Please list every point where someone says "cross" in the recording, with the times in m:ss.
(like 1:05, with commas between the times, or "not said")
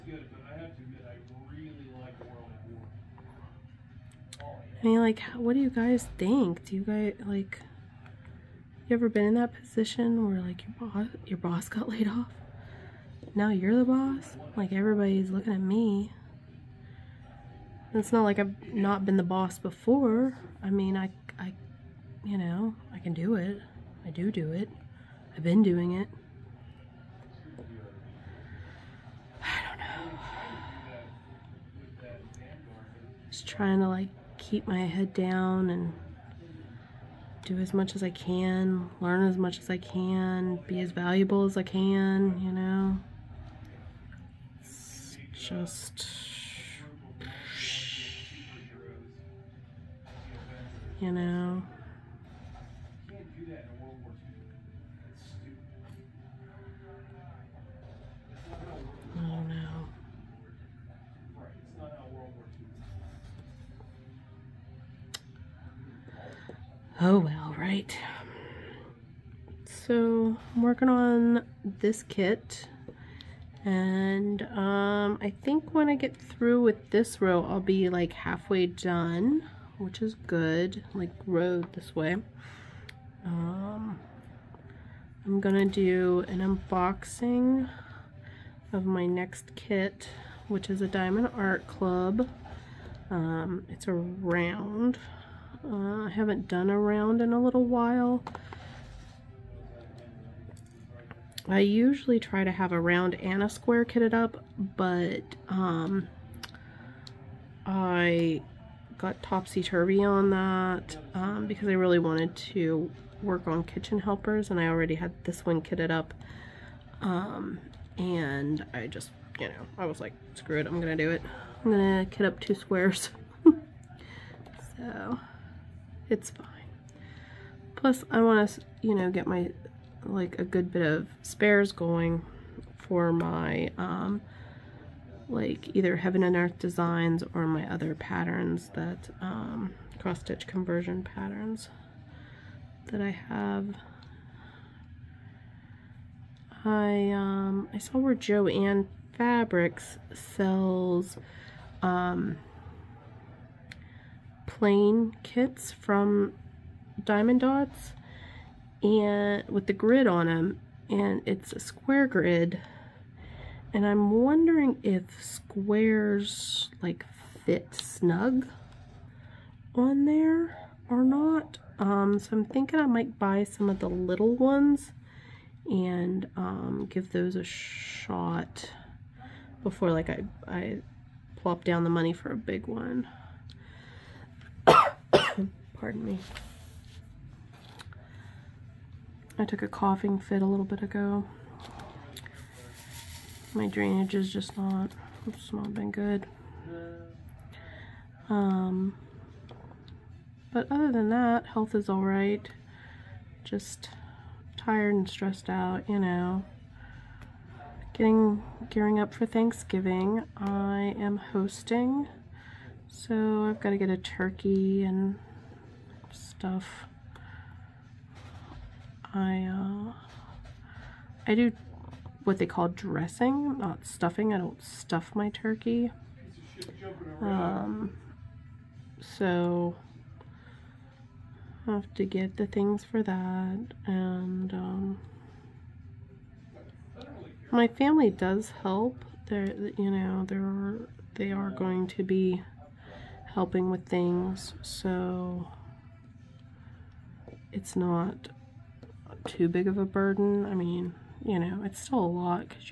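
2:19.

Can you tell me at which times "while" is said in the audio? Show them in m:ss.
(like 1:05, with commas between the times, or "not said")
1:37.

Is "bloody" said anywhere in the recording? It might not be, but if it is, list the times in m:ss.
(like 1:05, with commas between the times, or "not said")
not said.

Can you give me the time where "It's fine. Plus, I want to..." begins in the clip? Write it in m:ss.
2:06.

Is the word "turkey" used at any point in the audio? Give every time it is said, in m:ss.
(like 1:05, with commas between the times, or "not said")
3:33, 3:45.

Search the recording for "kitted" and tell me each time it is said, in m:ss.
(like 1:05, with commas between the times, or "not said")
1:43, 1:55.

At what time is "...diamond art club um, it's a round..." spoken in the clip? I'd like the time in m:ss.
1:30.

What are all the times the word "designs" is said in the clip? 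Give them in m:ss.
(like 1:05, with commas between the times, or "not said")
2:16.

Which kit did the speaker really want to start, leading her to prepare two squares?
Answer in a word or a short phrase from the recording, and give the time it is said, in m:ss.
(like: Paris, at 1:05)
Kitchen Helpers, at 1:53.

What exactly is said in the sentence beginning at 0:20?
I mean, I, I, you know, I can do it.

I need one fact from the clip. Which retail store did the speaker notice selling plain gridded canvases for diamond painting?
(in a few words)
Joann Fabrics.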